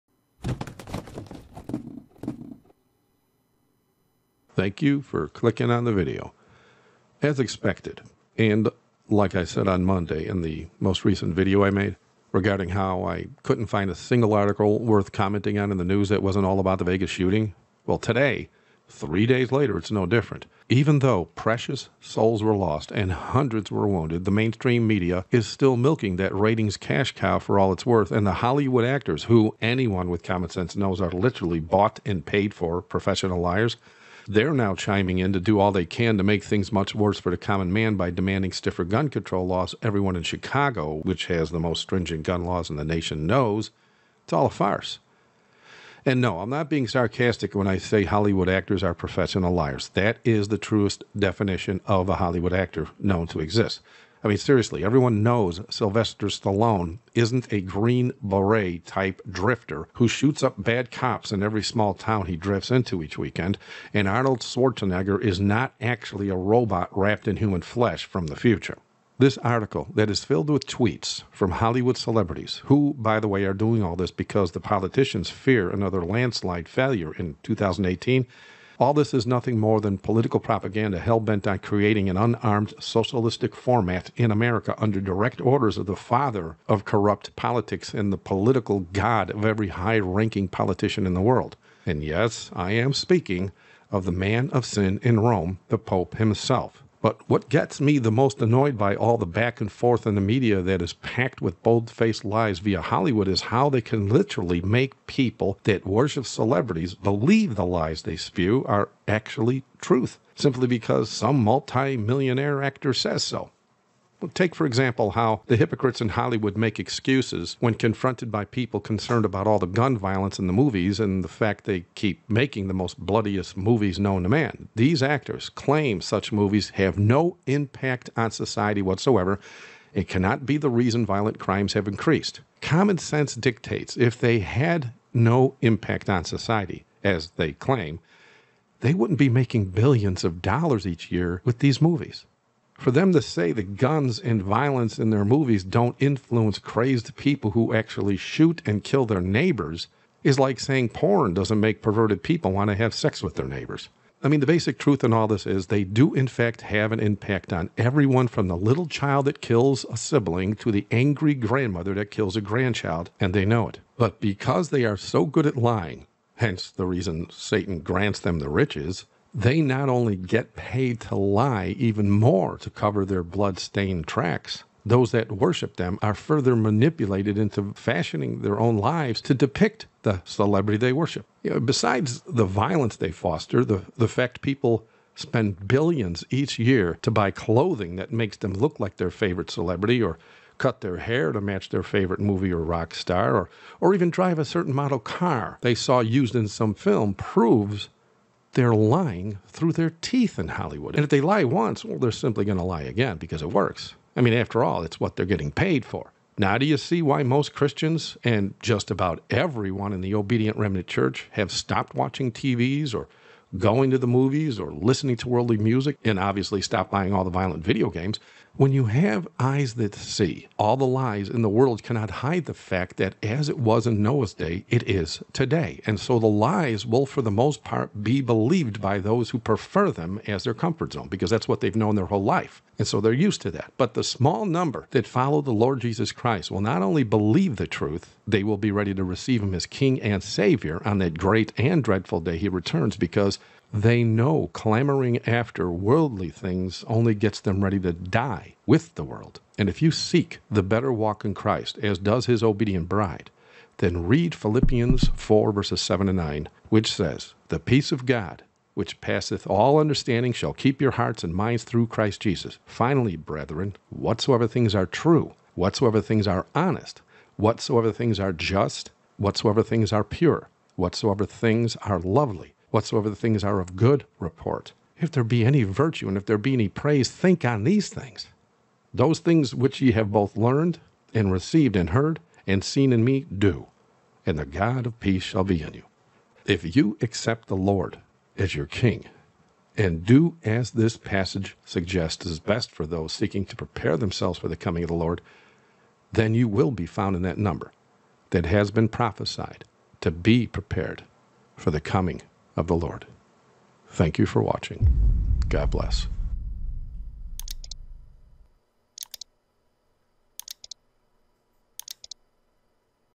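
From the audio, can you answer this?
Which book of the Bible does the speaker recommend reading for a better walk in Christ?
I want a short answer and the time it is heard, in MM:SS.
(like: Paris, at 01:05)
Philippians, at 04:14.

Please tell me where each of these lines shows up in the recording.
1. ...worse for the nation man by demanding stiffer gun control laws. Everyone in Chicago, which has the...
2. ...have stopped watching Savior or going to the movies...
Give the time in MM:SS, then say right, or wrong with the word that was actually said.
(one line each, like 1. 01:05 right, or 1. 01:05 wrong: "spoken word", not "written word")
1. 00:36 wrong: "common", not "nation"
2. 03:31 wrong: "TVs", not "Savior".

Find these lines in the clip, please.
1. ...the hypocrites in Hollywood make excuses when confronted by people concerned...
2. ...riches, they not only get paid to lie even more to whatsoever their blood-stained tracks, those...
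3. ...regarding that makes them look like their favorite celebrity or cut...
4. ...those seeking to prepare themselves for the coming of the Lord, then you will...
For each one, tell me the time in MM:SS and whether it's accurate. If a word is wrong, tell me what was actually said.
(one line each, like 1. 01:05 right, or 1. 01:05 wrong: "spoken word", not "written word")
1. 01:55 right
2. 02:48 wrong: "cover", not "whatsoever"
3. 03:07 wrong: "clothing", not "regarding"
4. 04:52 right.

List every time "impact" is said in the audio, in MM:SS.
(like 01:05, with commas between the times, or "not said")
02:07, 02:15, 02:36.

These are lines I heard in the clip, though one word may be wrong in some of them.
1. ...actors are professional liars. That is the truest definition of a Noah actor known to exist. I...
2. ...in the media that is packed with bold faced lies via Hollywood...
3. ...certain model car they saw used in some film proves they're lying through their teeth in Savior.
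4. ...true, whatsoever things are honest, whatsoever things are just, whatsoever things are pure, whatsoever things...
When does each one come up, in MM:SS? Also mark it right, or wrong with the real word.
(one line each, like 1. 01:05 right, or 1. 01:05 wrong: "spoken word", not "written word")
1. 00:48 wrong: "Hollywood", not "Noah"
2. 01:40 right
3. 03:14 wrong: "Hollywood", not "Savior"
4. 04:24 right.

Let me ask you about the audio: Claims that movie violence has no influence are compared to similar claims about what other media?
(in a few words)
Porn.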